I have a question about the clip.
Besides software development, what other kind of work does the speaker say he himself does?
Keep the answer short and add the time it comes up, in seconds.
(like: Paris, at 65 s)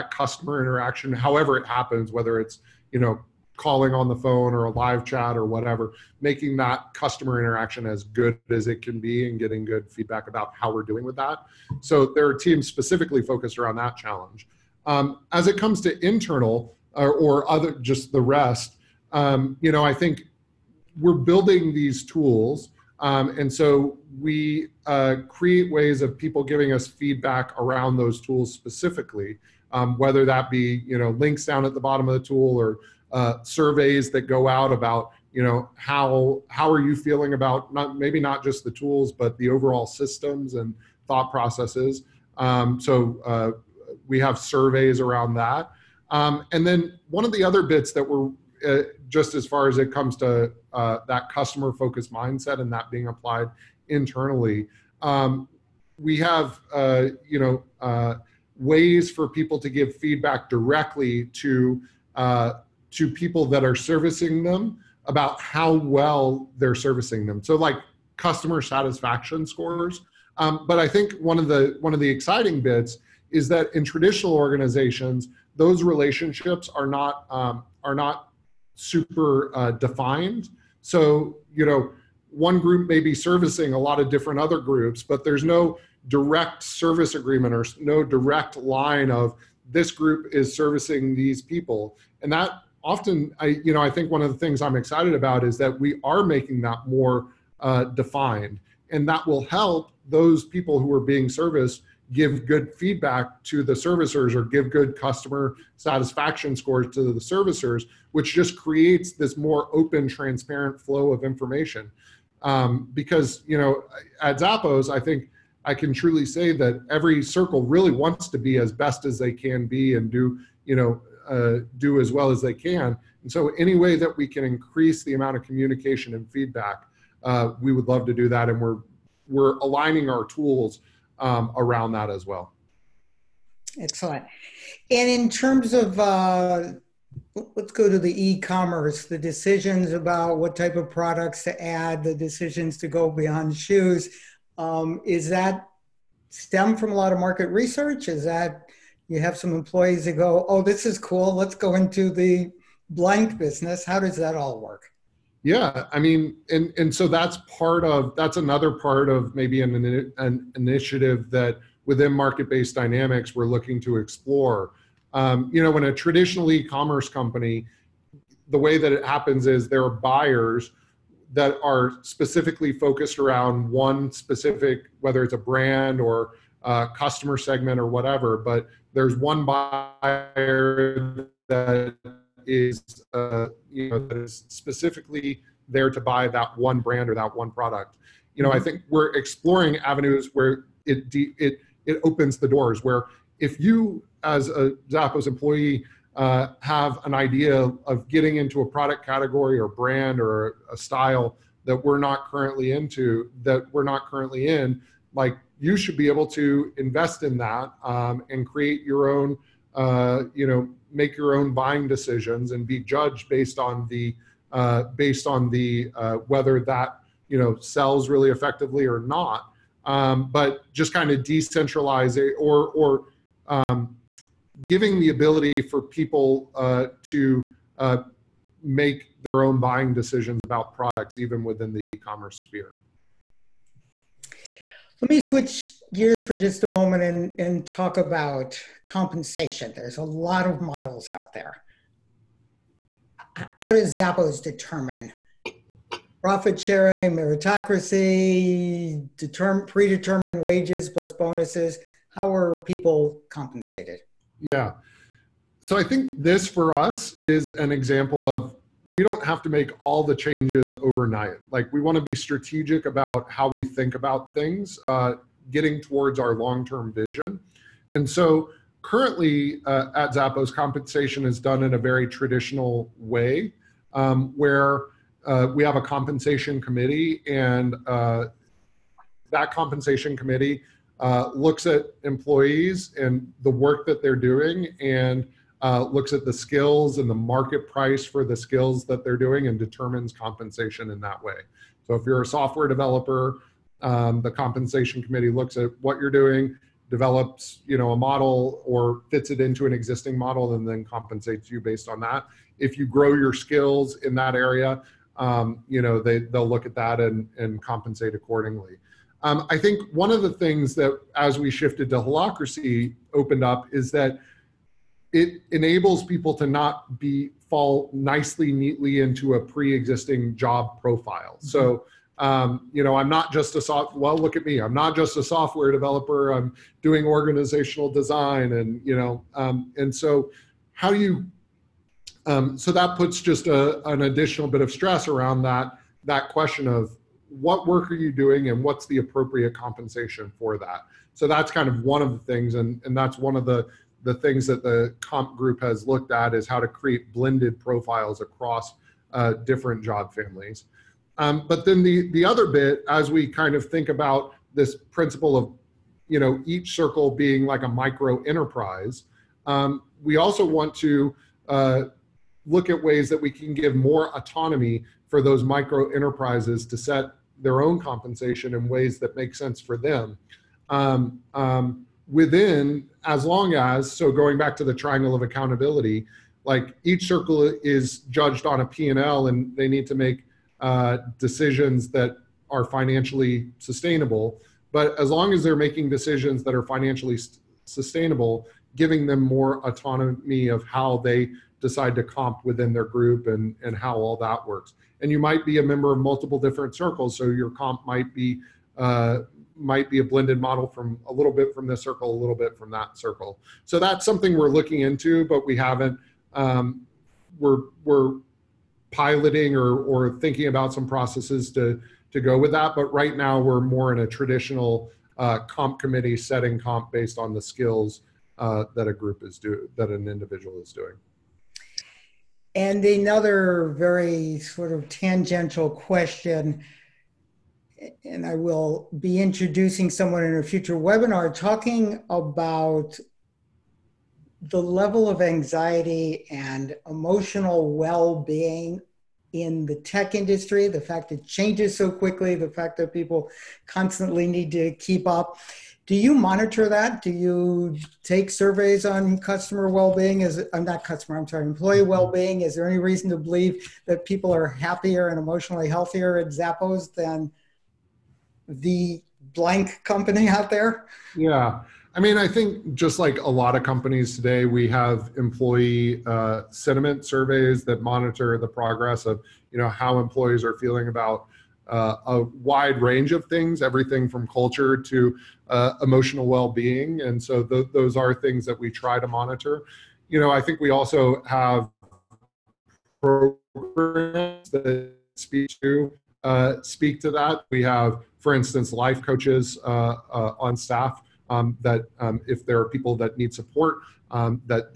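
organizational design, at 327 s.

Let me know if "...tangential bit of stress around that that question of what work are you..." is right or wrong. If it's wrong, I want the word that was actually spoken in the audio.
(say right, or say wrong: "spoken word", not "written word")
wrong: "additional", not "tangential".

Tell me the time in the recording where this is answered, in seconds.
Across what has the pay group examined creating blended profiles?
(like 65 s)
349 s.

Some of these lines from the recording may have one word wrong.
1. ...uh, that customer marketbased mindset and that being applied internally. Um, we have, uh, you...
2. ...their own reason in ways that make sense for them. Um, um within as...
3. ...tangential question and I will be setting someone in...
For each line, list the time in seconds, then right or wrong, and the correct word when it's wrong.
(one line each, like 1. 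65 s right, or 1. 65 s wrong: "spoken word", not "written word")
1. 50 s wrong: "focused", not "marketbased"
2. 367 s wrong: "compensation", not "reason"
3. 424 s wrong: "introducing", not "setting".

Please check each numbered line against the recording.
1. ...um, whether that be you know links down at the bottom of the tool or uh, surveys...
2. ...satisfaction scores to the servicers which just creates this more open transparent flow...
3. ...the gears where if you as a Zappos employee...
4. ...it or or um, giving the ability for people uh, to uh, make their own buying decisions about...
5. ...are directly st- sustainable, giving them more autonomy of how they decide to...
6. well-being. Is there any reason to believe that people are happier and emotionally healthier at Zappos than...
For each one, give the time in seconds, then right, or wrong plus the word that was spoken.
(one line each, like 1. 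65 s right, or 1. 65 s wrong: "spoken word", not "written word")
1. 29 s right
2. 105 s right
3. 192 s wrong: "doors", not "gears"
4. 222 s right
5. 386 s wrong: "financially", not "directly"
6. 451 s right.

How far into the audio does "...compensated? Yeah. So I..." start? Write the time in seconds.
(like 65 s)
253 s.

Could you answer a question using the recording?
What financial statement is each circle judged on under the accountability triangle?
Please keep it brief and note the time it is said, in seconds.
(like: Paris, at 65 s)
P&L, at 378 s.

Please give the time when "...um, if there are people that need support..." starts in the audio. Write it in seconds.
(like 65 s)
491 s.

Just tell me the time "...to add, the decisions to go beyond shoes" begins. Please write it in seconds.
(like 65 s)
141 s.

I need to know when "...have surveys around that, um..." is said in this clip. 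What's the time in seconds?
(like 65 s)
44 s.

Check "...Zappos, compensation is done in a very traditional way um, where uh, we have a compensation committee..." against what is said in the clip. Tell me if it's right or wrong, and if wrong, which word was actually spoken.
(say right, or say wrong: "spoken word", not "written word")
right.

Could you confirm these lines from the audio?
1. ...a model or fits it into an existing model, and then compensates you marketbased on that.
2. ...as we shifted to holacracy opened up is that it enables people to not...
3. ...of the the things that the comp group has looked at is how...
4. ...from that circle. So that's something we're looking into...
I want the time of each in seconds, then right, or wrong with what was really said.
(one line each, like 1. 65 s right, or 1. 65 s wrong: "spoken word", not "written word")
1. 297 s wrong: "based", not "marketbased"
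2. 311 s right
3. 343 s right
4. 402 s right.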